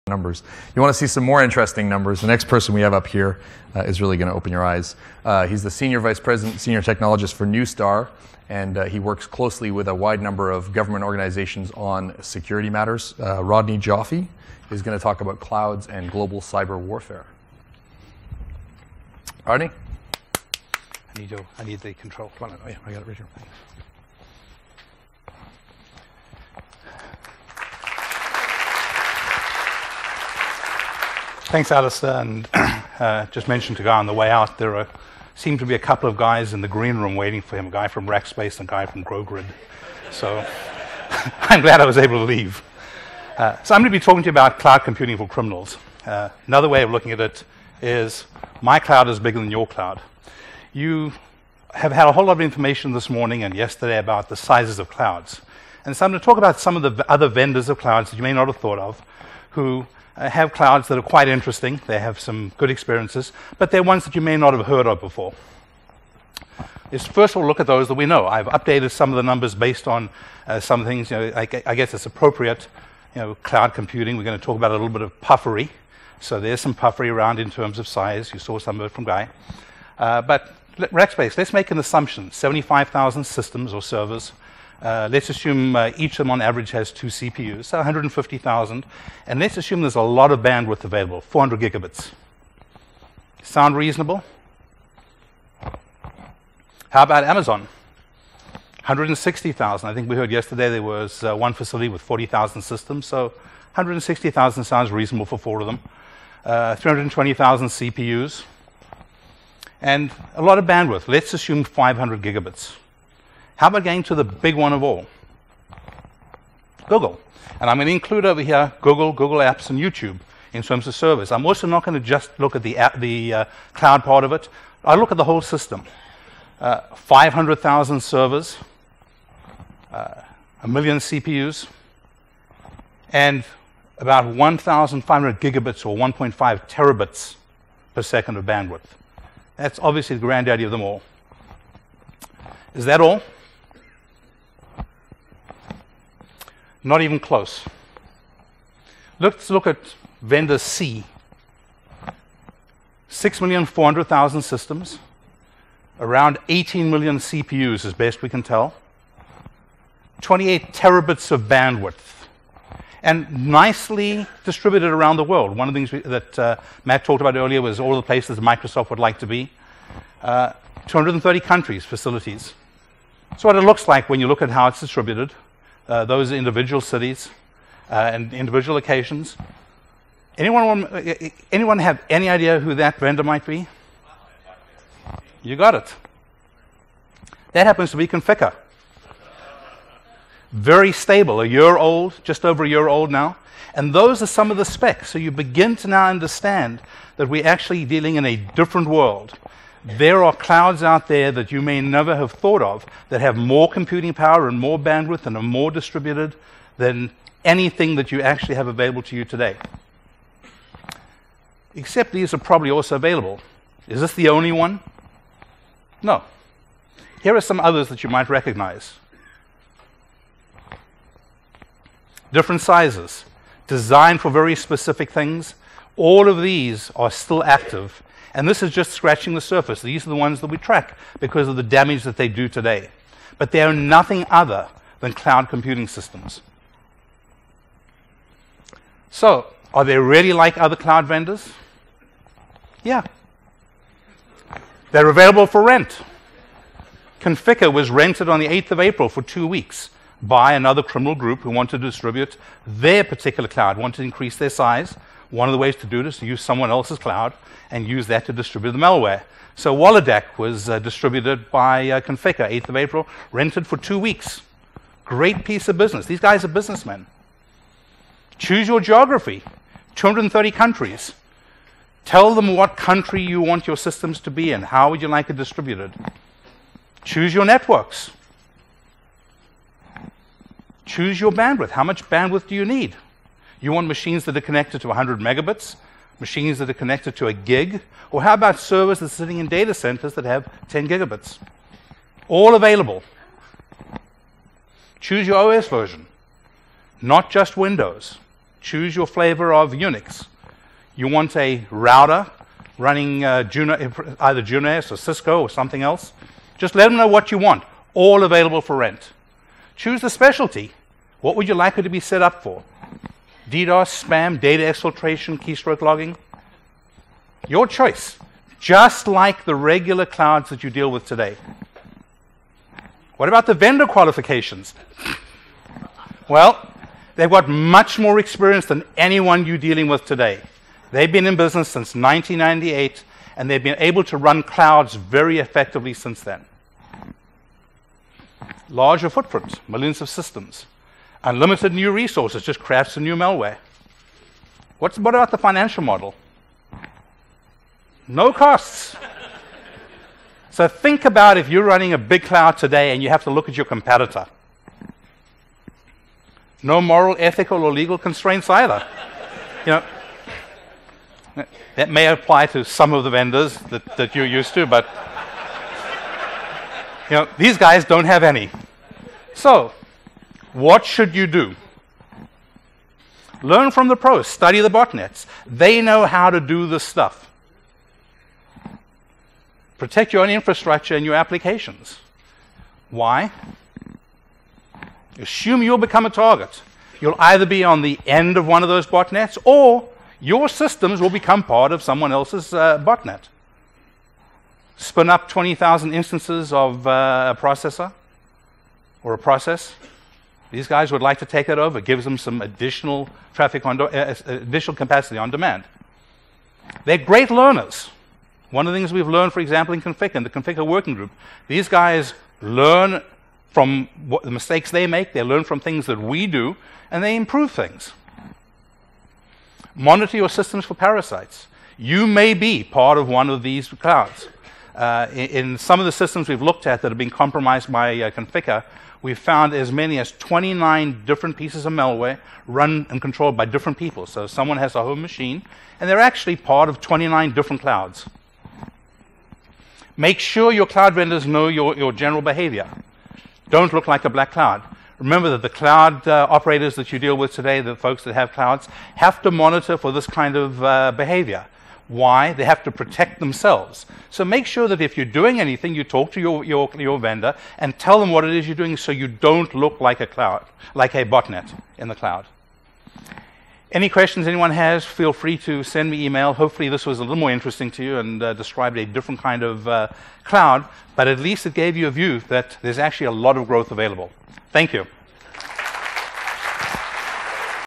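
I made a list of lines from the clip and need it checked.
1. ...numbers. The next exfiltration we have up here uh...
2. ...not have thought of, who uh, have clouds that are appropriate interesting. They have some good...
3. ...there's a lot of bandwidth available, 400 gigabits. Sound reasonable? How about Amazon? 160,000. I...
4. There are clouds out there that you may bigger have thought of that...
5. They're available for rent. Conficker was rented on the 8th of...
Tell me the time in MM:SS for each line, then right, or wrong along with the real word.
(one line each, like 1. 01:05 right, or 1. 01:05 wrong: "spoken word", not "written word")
1. 00:01 wrong: "person", not "exfiltration"
2. 00:58 wrong: "quite", not "appropriate"
3. 01:29 right
4. 03:19 wrong: "never", not "bigger"
5. 04:04 right.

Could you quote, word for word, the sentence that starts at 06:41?
It gives them some additional traffic on uh, uh, additional capacity on demand.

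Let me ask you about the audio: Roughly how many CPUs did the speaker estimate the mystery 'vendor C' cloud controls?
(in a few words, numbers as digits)
18 million.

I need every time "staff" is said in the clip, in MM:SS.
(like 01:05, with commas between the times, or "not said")
not said.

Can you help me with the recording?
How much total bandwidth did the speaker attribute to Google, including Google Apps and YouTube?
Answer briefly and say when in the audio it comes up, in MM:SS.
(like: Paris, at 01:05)
1.5 terabits per second, at 02:15.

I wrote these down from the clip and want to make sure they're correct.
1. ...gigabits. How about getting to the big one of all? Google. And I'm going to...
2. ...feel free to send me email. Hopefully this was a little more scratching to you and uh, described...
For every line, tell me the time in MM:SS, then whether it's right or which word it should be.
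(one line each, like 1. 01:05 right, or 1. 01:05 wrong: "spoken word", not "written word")
1. 01:52 right
2. 07:44 wrong: "interesting", not "scratching".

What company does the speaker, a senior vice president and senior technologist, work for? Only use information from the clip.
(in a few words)
Neustar.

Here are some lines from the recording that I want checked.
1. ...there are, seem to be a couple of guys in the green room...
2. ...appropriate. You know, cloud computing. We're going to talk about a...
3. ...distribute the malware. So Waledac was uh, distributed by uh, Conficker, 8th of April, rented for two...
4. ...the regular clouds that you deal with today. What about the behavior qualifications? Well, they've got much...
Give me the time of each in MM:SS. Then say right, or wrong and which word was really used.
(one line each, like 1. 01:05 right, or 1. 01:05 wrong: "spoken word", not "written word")
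1. 00:34 right
2. 01:12 right
3. 04:18 right
4. 05:19 wrong: "vendor", not "behavior".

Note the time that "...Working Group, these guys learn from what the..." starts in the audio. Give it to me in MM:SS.
06:50.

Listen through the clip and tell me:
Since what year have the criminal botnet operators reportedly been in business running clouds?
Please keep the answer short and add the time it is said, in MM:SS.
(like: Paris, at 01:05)
1998, at 05:31.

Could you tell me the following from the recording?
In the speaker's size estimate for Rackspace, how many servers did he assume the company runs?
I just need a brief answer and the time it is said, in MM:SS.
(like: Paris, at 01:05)
75,000, at 01:22.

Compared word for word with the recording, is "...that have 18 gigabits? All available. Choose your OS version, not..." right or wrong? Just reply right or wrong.
wrong.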